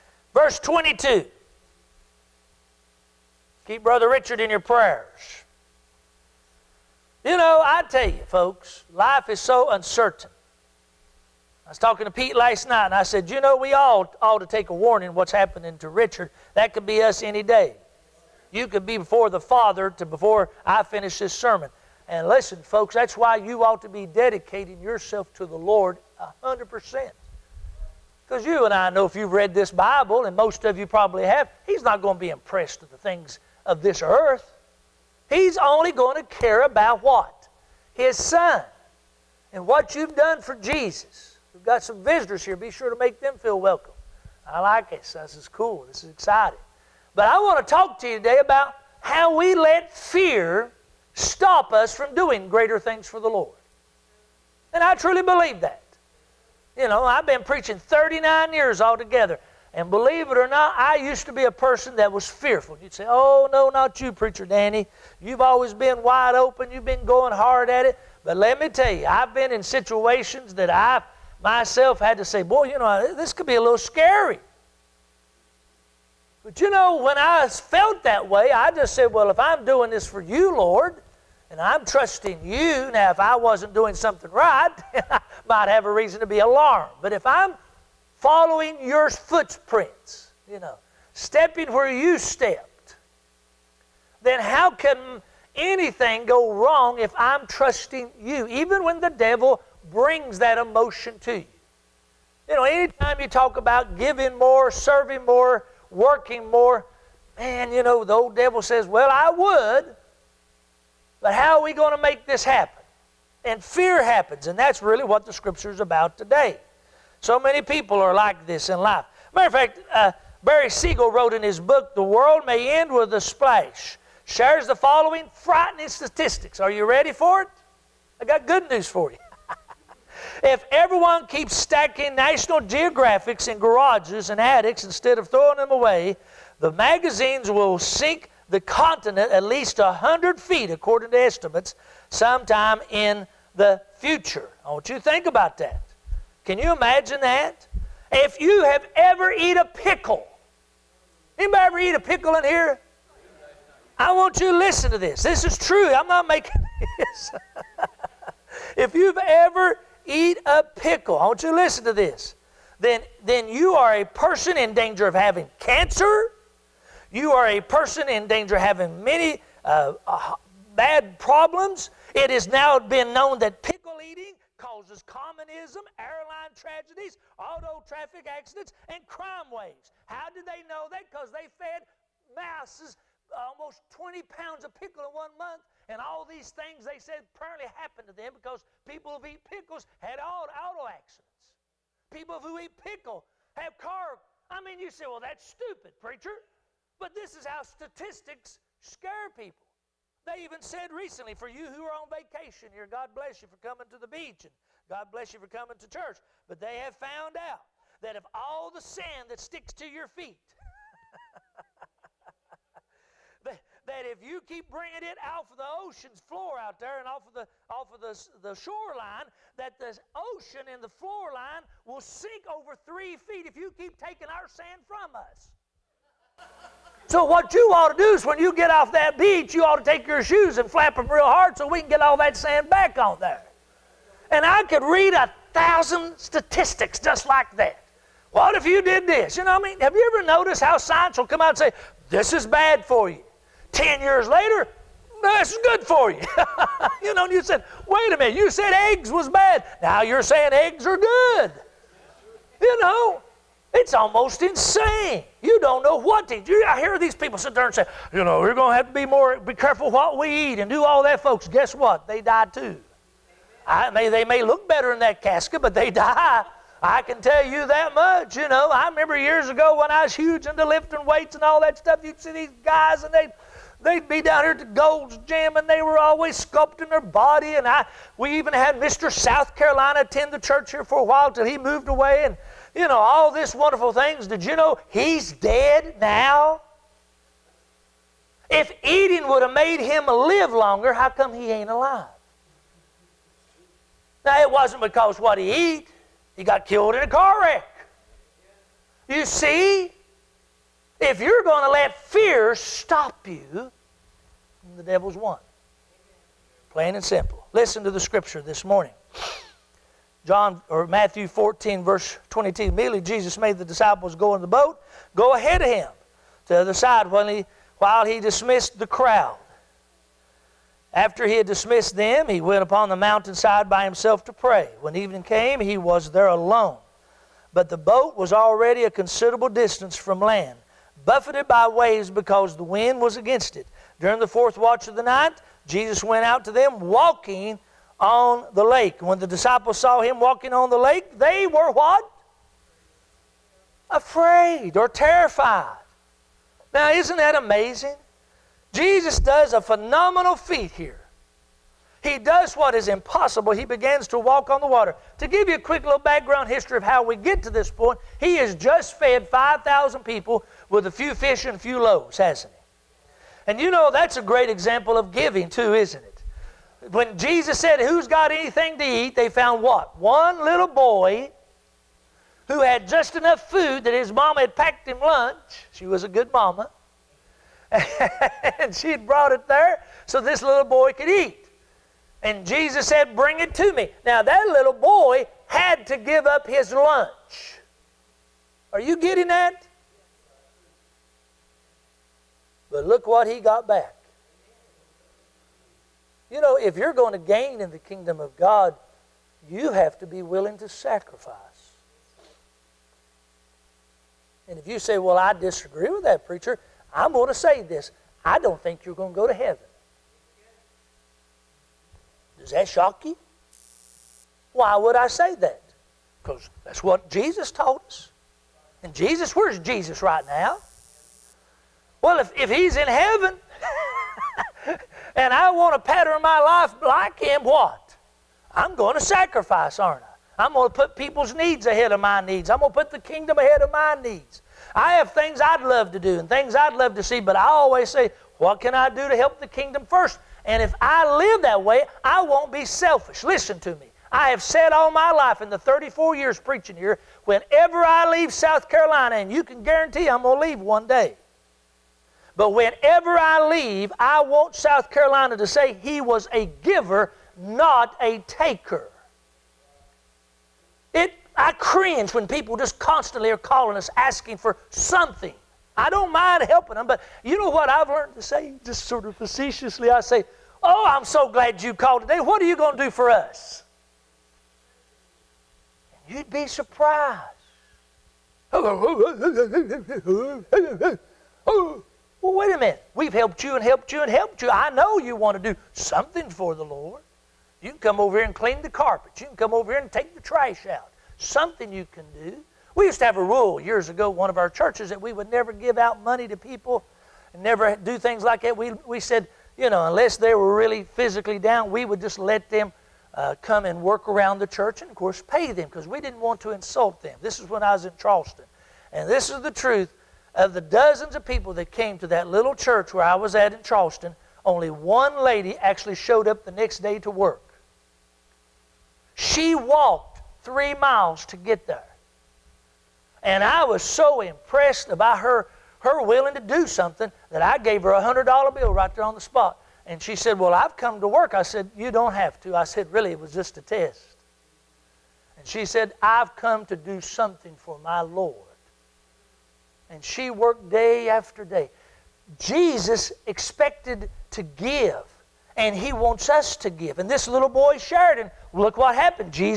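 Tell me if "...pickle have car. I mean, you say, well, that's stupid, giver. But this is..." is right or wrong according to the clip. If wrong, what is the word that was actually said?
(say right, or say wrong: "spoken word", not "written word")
wrong: "preacher", not "giver".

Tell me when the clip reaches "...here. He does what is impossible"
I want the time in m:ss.
5:50.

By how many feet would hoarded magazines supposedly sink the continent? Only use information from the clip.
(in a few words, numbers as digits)
100 feet.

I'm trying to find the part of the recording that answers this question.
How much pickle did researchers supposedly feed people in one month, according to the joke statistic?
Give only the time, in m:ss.
3:03.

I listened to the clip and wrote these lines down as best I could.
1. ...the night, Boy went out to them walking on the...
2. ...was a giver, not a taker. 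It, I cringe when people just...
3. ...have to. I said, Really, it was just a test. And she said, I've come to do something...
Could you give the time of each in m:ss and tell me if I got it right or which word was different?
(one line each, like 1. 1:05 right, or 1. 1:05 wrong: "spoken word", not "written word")
1. 5:34 wrong: "Jesus", not "Boy"
2. 7:36 right
3. 8:52 right.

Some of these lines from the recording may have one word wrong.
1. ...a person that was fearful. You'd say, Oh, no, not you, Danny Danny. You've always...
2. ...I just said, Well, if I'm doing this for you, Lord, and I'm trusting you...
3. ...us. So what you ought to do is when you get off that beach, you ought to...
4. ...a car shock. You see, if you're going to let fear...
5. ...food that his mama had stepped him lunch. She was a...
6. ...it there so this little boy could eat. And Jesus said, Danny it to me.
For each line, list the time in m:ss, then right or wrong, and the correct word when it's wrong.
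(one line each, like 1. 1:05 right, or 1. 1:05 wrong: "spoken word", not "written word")
1. 1:01 wrong: "Preacher", not "Danny"
2. 1:18 right
3. 3:45 right
4. 4:57 wrong: "wreck", not "shock"
5. 6:13 wrong: "packed", not "stepped"
6. 6:19 wrong: "Bring", not "Danny".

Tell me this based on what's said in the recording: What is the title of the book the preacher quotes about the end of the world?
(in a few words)
The World May End with a Splash.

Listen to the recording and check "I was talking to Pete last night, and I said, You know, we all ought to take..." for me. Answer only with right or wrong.
right.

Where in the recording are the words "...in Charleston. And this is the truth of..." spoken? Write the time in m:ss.
8:27.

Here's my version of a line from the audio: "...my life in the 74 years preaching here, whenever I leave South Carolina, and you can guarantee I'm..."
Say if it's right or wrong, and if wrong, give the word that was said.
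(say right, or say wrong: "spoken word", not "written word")
wrong: "34", not "74".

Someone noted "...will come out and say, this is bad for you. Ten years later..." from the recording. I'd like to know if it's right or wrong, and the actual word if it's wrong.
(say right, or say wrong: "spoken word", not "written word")
right.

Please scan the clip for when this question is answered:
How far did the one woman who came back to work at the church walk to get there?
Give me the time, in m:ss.
8:40.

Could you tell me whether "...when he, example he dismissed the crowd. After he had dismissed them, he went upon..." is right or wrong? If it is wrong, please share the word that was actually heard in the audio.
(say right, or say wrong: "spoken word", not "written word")
wrong: "while", not "example".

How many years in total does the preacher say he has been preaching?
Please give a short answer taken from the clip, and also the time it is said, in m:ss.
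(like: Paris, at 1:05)
39, at 0:57.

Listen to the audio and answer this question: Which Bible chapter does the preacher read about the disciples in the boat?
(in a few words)
Matthew 14.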